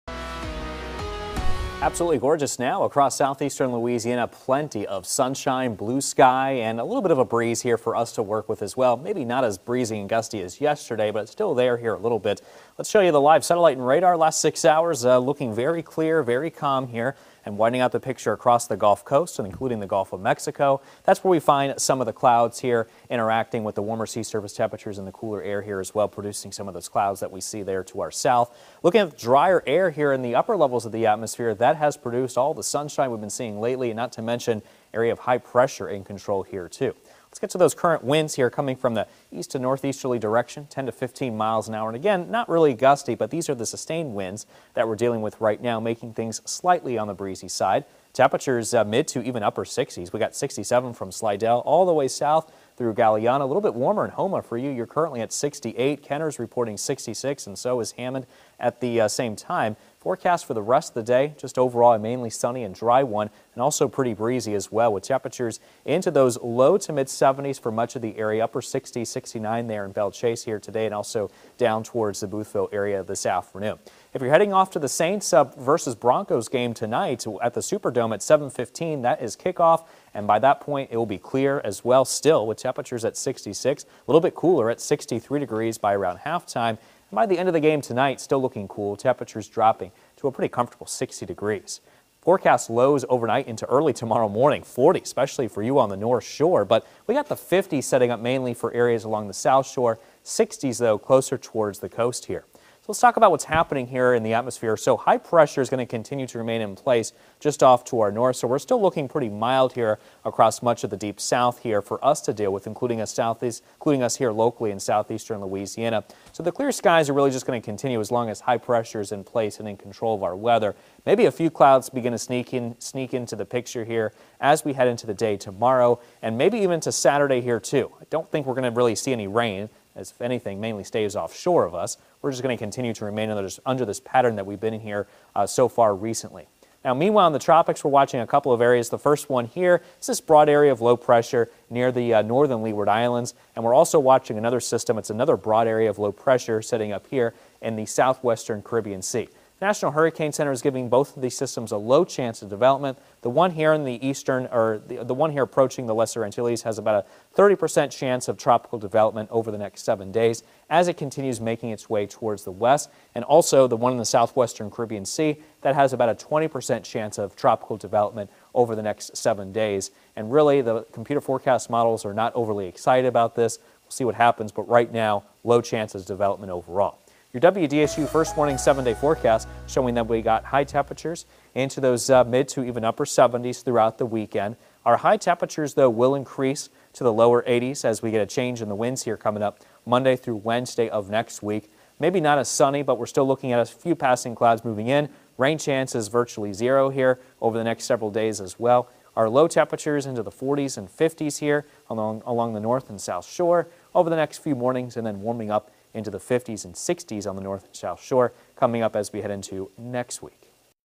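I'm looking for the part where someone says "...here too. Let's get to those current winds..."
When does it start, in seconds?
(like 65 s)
36 s.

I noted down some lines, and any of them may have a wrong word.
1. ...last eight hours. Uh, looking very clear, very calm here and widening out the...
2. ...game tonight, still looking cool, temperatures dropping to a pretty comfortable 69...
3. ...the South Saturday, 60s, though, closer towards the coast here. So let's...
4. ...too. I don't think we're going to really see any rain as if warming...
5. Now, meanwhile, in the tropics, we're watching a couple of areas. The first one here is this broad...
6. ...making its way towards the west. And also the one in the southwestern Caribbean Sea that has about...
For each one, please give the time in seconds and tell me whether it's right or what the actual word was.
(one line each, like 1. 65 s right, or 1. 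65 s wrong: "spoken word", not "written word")
1. 14 s wrong: "six", not "eight"
2. 87 s wrong: "60", not "69"
3. 99 s wrong: "Shore", not "Saturday"
4. 127 s wrong: "anything", not "warming"
5. 136 s right
6. 161 s right.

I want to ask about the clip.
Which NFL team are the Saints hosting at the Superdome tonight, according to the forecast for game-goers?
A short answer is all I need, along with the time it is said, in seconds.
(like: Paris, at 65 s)
Broncos, at 75 s.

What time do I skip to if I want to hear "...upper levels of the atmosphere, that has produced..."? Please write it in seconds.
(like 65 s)
30 s.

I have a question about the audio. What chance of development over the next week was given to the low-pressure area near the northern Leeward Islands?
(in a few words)
30%.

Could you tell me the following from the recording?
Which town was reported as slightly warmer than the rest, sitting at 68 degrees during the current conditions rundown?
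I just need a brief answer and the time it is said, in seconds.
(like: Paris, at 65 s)
Houma, at 54 s.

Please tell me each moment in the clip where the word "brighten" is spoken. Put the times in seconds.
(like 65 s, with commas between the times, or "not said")
not said.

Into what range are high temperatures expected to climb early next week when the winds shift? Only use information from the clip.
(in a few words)
lower 80s.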